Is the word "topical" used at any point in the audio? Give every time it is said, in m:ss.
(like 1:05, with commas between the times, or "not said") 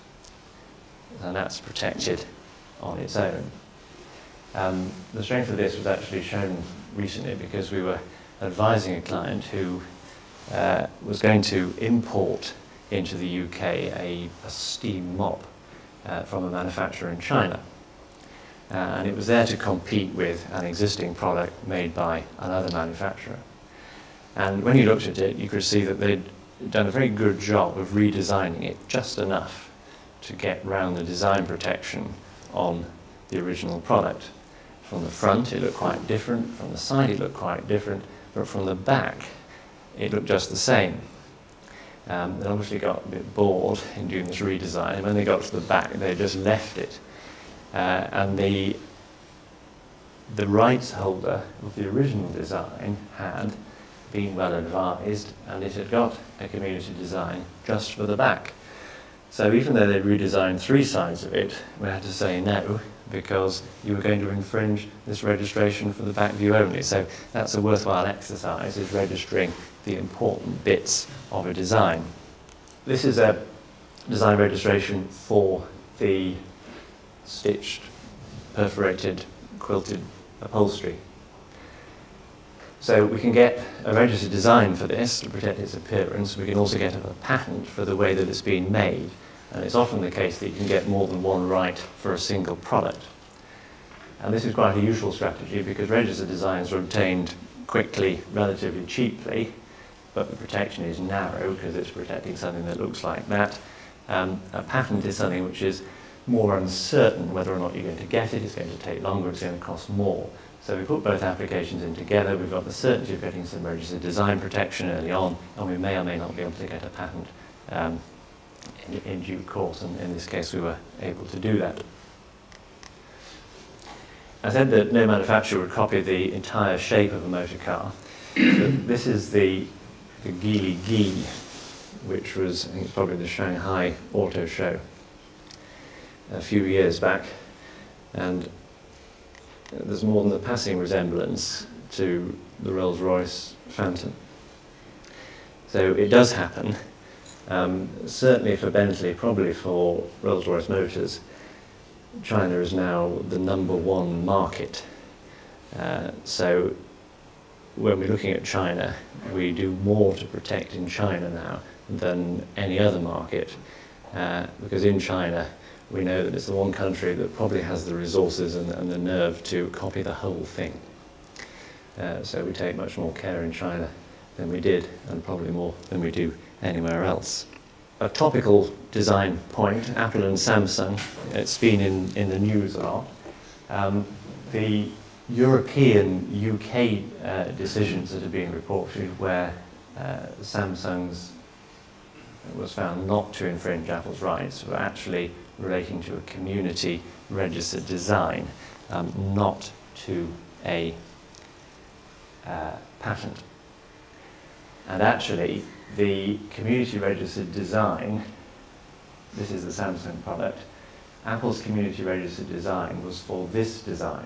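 2:58.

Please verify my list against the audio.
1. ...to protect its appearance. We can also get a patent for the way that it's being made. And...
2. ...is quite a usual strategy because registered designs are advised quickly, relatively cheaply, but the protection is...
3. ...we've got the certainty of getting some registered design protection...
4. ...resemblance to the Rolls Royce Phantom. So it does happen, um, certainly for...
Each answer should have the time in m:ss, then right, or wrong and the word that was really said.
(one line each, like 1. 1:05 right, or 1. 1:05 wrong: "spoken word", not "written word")
1. 1:25 right
2. 1:34 wrong: "obtained", not "advised"
3. 1:52 right
4. 2:20 right.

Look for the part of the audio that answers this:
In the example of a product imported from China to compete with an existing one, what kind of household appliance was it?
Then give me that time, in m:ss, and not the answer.
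0:14.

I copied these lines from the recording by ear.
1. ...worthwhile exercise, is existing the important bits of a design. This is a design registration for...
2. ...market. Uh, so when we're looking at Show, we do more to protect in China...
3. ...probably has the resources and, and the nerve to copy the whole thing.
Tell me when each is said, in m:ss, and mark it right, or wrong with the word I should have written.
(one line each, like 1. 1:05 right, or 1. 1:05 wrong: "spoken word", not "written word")
1. 1:07 wrong: "registering", not "existing"
2. 2:34 wrong: "China", not "Show"
3. 2:47 right.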